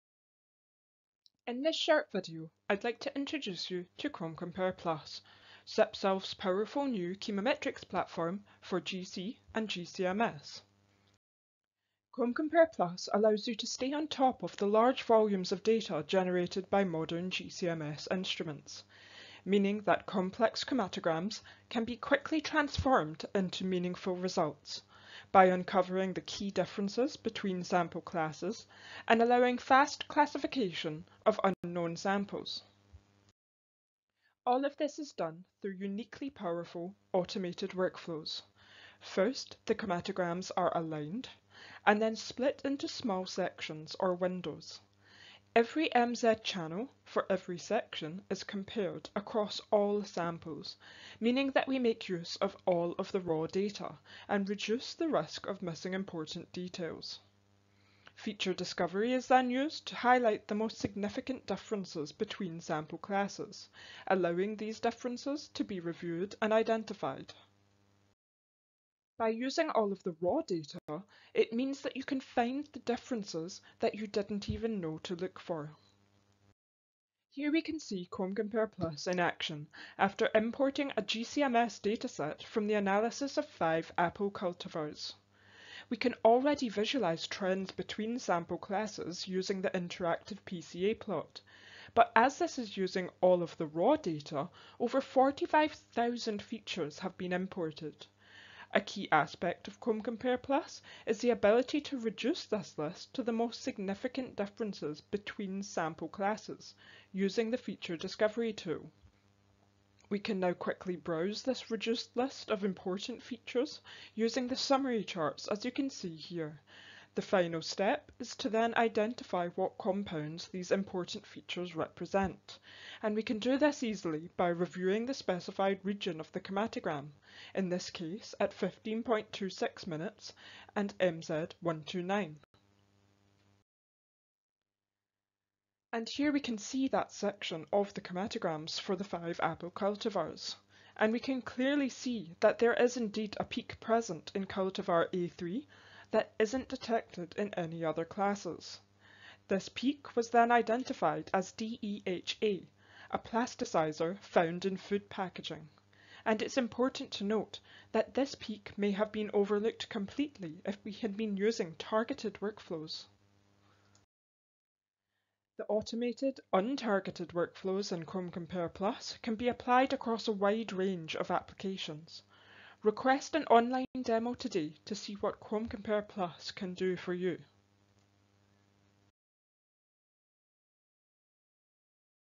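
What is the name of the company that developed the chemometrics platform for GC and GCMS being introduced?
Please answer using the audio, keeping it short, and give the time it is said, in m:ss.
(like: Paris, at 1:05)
SepSolve, at 0:05.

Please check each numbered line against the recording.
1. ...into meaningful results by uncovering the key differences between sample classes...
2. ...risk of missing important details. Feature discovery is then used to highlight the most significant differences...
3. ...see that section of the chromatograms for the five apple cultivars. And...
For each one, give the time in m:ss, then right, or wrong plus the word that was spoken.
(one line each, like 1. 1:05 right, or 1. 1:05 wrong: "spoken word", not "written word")
1. 0:23 right
2. 0:55 right
3. 2:16 right.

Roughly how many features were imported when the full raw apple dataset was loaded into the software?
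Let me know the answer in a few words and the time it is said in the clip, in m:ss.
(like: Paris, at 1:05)
over 45,000, at 1:34.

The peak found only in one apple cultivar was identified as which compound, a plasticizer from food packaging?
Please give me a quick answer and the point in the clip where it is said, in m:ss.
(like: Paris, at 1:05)
DEHA, at 2:31.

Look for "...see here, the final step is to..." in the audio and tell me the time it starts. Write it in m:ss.
1:55.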